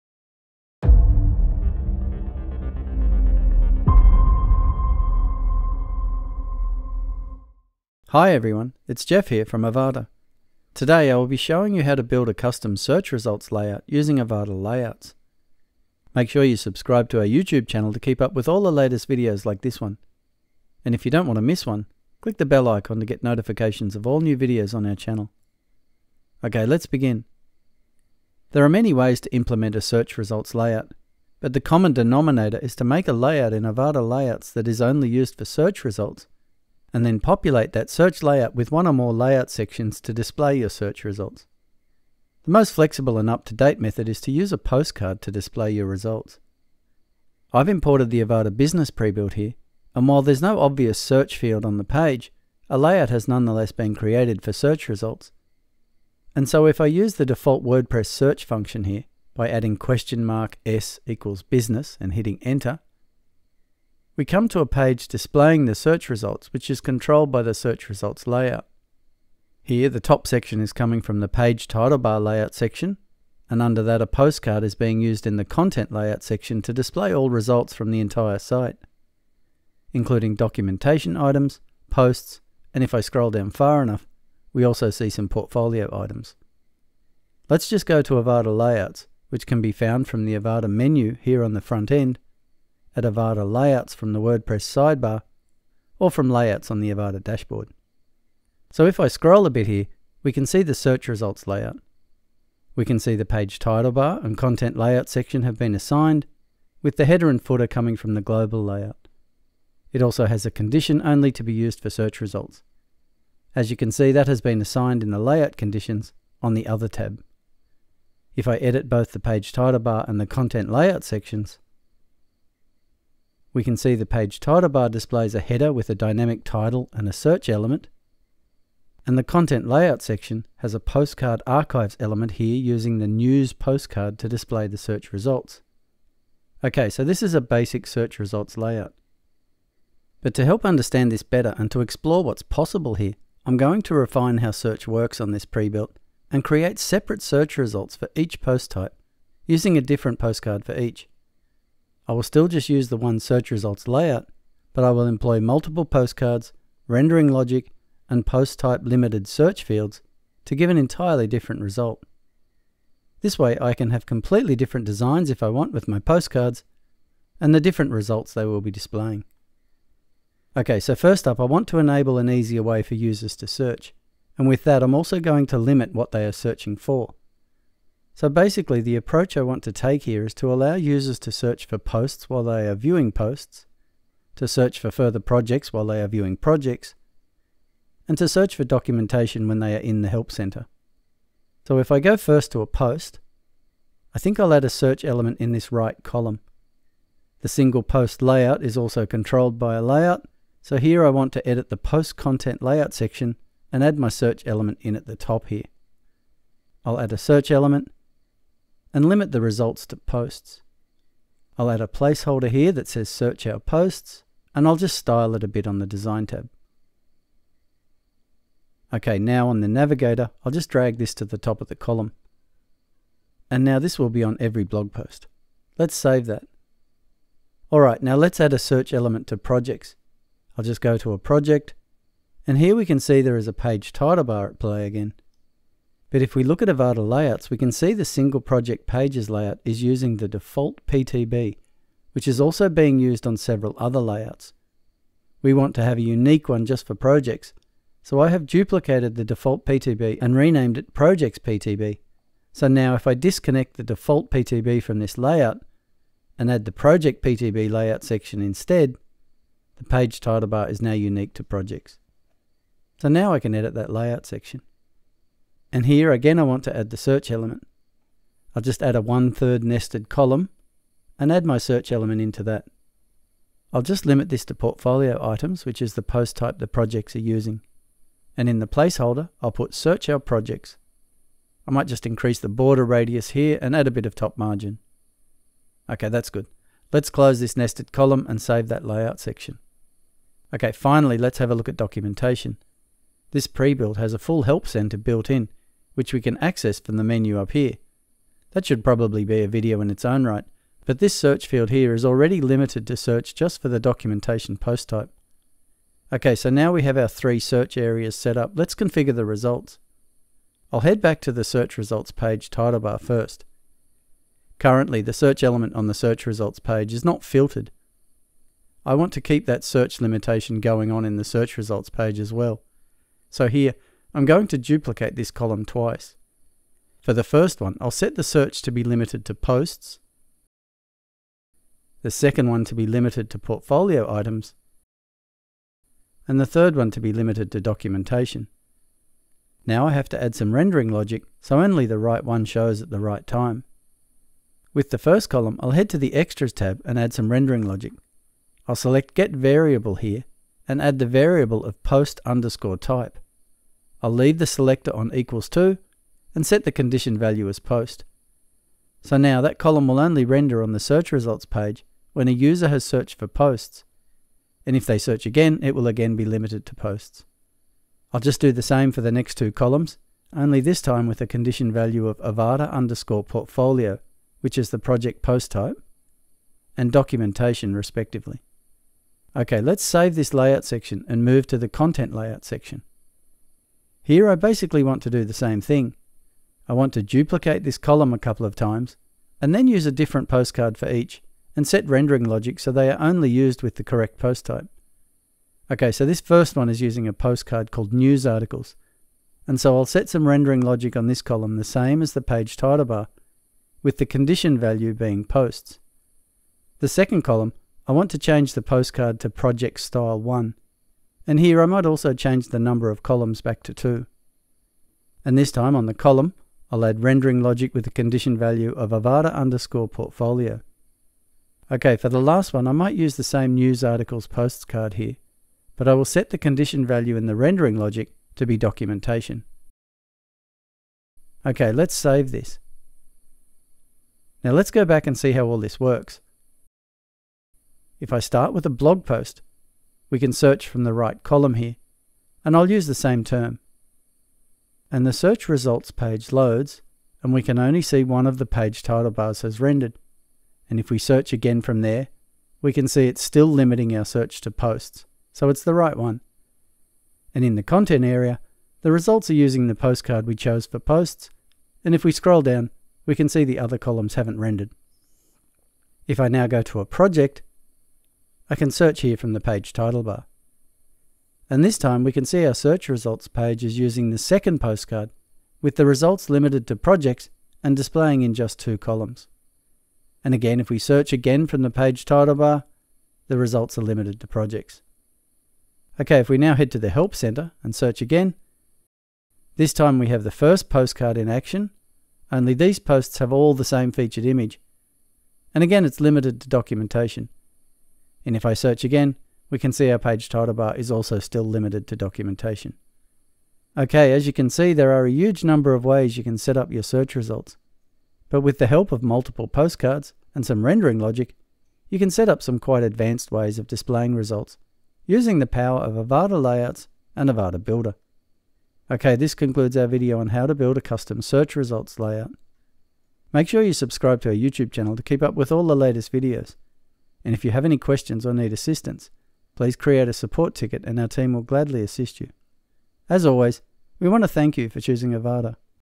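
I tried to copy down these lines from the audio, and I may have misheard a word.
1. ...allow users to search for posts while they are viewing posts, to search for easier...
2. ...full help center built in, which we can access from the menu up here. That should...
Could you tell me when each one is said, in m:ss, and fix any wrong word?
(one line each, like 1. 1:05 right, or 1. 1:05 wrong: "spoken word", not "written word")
1. 3:00 wrong: "further", not "easier"
2. 4:54 right.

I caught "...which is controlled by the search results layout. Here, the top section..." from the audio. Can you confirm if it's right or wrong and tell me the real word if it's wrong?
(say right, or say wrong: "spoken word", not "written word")
right.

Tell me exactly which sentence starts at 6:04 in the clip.
And if they search again, it will again be limited to posts.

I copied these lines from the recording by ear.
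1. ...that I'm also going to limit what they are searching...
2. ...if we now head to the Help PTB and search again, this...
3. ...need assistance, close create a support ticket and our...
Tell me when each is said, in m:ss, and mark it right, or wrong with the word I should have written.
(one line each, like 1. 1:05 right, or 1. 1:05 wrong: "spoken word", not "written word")
1. 2:54 right
2. 8:06 wrong: "Center", not "PTB"
3. 8:48 wrong: "please", not "close".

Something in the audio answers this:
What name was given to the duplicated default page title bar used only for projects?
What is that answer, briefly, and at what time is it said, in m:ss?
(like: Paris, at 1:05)
Projects PTB, at 4:10.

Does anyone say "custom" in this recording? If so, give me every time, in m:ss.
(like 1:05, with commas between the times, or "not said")
0:12, 8:40.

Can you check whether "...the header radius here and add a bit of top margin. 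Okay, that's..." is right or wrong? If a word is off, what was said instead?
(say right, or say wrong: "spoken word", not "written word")
wrong: "border", not "header".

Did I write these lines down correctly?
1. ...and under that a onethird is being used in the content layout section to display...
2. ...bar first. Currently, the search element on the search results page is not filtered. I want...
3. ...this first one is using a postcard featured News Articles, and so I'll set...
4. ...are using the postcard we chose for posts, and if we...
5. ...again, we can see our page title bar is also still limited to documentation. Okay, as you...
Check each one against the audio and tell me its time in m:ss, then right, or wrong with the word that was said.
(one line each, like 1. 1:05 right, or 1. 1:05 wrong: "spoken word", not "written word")
1. 1:13 wrong: "postcard", not "onethird"
2. 5:12 right
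3. 6:36 wrong: "called", not "featured"
4. 7:39 right
5. 8:18 right.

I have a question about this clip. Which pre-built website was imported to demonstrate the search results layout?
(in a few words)
Avada Business.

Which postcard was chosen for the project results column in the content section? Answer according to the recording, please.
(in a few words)
Project Style 1.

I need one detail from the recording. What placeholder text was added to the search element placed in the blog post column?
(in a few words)
search our posts.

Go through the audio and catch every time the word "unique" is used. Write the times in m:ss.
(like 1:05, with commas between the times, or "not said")
4:06, 4:20.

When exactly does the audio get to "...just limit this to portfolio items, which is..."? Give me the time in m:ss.
4:33.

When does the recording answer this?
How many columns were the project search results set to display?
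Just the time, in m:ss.
6:53.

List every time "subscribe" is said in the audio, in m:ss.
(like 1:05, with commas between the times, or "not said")
0:16, 8:43.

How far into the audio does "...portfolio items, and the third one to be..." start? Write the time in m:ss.
5:33.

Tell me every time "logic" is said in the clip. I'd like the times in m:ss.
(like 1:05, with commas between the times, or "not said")
2:37, 5:40, 5:47, 6:32, 6:40, 6:57, 7:07, 8:30.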